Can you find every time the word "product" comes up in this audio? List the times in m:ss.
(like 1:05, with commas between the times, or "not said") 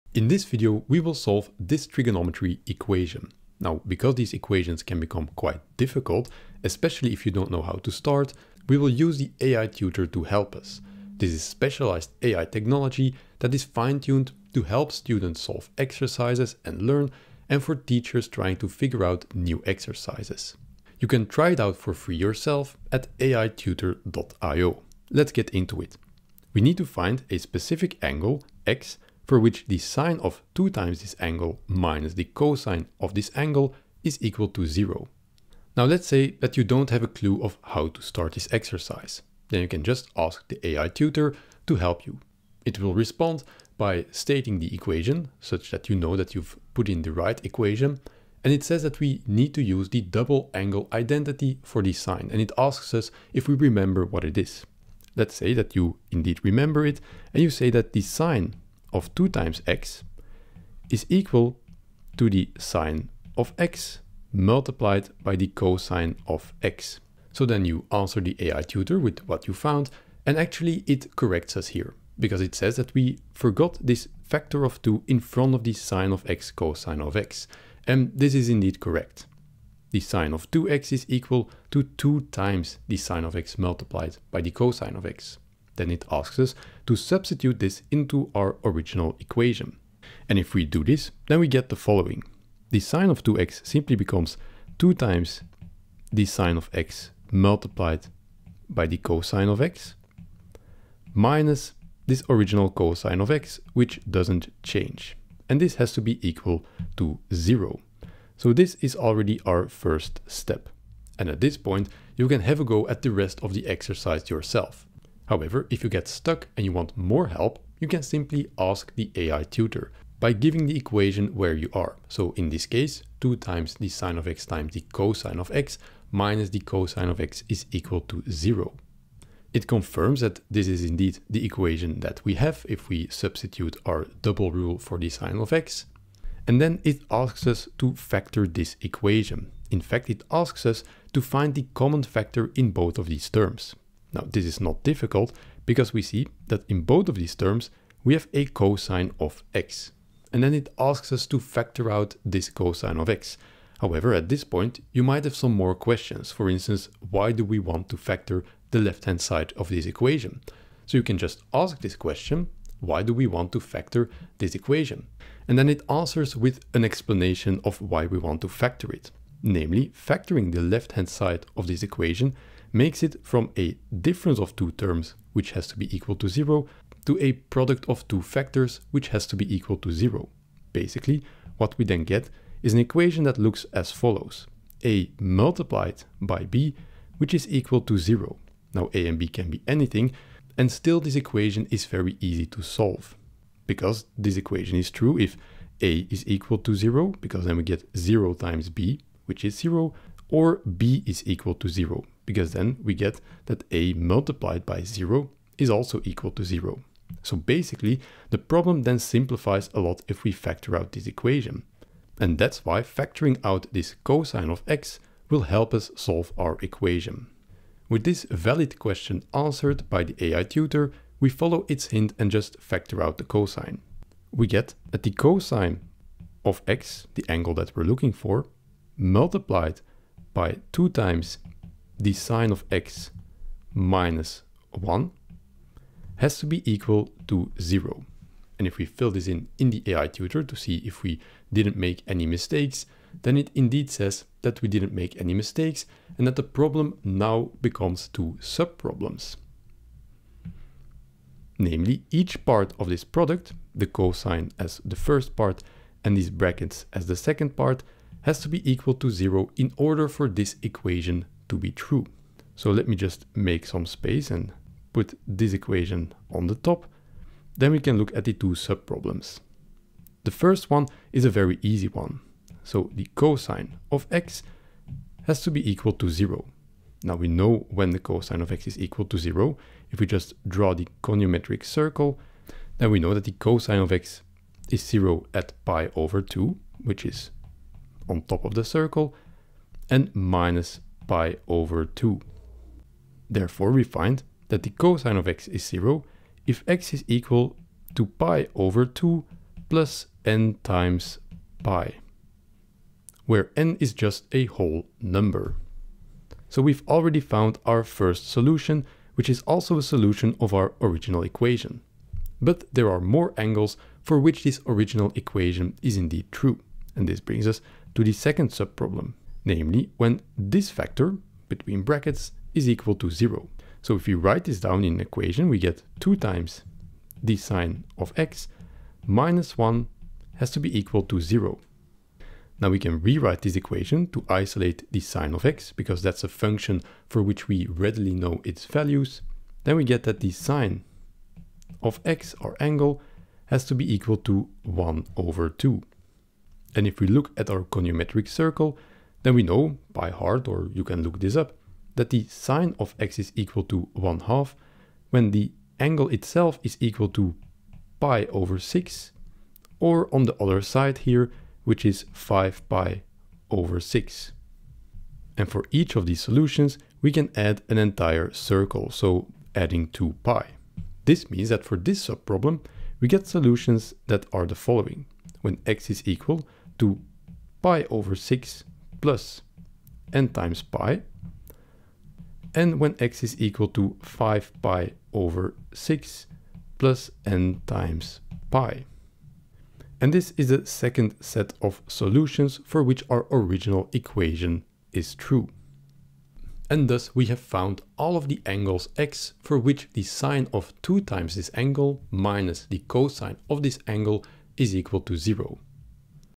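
2:57, 4:13.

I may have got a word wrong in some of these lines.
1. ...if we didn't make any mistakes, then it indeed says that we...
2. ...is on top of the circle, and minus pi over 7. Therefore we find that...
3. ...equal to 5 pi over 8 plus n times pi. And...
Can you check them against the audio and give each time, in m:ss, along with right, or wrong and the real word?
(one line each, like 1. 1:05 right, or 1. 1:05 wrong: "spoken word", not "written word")
1. 4:00 right
2. 4:47 wrong: "2", not "7"
3. 6:23 wrong: "6", not "8".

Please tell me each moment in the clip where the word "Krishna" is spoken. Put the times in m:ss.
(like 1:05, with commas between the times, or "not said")
not said.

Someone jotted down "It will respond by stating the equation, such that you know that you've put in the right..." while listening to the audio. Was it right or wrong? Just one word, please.
right.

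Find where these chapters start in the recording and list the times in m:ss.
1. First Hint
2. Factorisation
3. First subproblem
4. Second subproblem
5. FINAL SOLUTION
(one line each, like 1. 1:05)
1. 0:48
2. 2:20
3. 4:30
4. 5:13
5. 6:30.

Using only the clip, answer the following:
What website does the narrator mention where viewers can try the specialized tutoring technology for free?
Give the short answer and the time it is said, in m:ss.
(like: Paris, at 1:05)
aitutor.io, at 0:23.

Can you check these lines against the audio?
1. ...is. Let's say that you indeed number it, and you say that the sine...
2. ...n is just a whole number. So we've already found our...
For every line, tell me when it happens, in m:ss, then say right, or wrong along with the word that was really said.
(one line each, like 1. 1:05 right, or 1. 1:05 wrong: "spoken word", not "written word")
1. 0:54 wrong: "remember", not "number"
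2. 5:03 right.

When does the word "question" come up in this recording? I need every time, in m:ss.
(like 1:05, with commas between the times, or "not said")
2:35, 2:41, 3:38.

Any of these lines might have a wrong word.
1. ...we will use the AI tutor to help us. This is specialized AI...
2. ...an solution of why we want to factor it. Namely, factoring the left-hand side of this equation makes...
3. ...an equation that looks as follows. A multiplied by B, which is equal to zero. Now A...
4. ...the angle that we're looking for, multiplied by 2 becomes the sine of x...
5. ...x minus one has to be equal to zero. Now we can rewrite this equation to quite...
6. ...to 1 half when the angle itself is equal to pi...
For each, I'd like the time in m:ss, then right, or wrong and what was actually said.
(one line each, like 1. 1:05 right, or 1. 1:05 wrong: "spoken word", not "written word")
1. 0:08 right
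2. 2:46 wrong: "explanation", not "solution"
3. 3:02 right
4. 3:47 wrong: "times", not "becomes"
5. 5:28 wrong: "isolate", not "quite"
6. 5:53 right.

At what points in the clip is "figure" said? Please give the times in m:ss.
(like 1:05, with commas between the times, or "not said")
0:18.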